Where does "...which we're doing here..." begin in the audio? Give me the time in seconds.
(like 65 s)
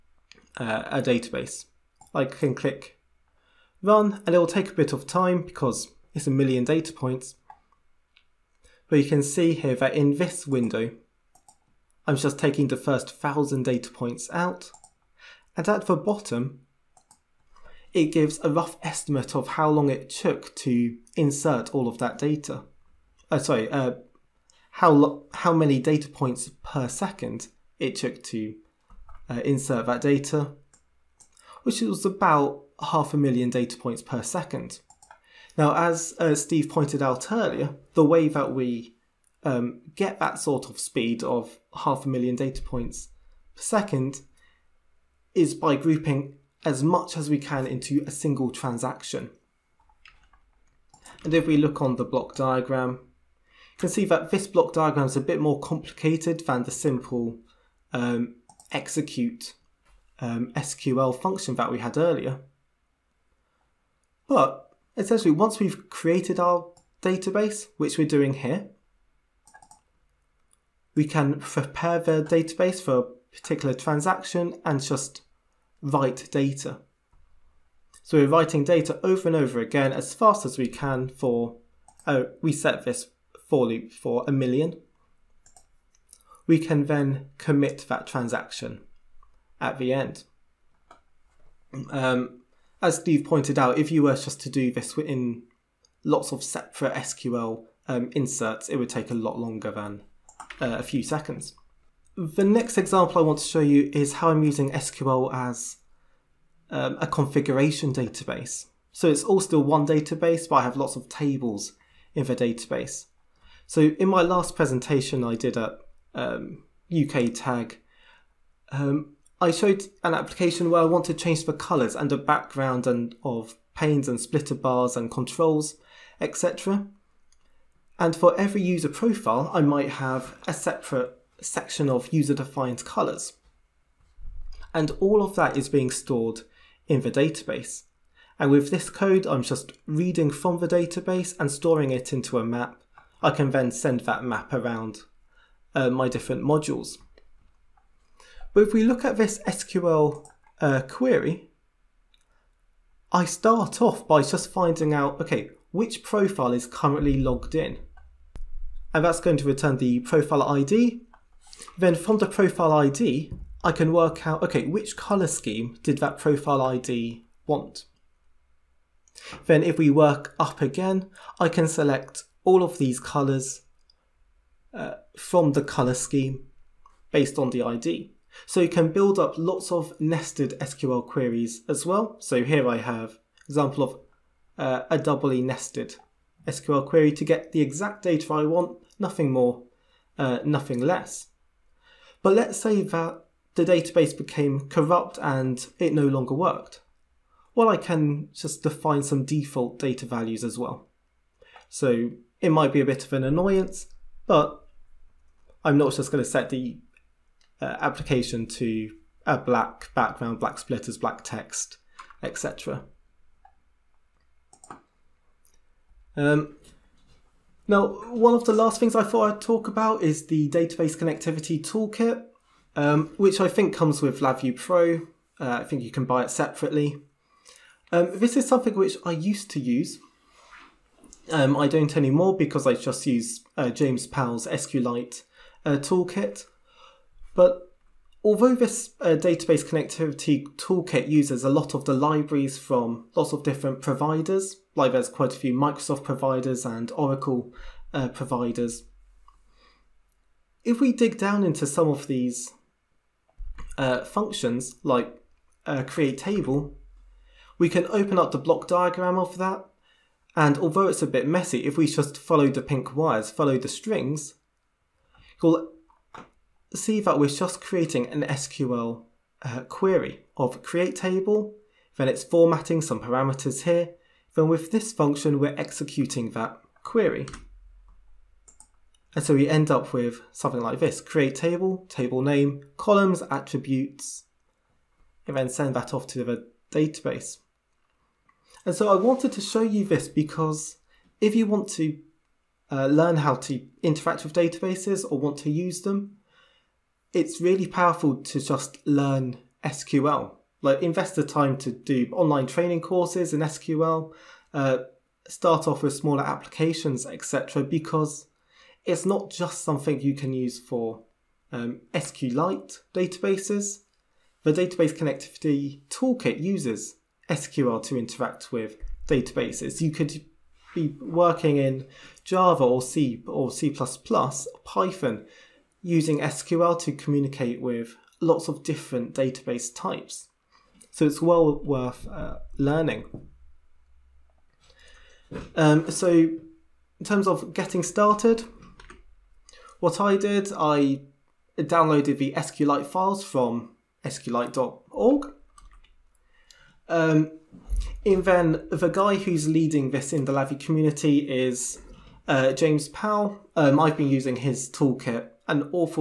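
67 s.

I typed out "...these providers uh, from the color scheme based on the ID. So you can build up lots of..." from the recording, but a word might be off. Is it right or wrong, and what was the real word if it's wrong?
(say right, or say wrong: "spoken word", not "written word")
wrong: "colors", not "providers".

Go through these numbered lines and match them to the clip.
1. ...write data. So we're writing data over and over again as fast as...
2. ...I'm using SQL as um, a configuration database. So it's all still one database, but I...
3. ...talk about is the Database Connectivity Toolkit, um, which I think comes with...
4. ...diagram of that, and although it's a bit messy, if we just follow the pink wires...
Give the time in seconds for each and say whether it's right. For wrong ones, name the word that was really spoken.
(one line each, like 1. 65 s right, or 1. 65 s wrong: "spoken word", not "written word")
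1. 75 s right
2. 104 s right
3. 219 s right
4. 258 s right.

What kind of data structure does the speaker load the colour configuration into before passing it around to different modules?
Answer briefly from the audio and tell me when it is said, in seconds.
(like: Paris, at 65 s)
a map, at 141 s.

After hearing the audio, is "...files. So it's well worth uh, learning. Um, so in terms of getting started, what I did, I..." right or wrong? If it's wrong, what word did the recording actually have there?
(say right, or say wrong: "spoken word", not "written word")
wrong: "types", not "files".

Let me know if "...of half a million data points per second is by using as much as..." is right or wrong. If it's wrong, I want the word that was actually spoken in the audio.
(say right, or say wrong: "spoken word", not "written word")
wrong: "grouping", not "using".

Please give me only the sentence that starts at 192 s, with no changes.
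But let's say that the database became corrupt and it no longer worked.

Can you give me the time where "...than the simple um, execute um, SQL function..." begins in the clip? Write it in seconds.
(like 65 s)
56 s.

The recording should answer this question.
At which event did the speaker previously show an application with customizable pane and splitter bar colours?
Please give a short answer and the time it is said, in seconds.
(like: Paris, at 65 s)
UK Tag, at 116 s.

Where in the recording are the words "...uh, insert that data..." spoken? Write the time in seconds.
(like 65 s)
29 s.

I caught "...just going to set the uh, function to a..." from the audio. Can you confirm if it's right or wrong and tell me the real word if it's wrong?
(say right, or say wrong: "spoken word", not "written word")
wrong: "application", not "function".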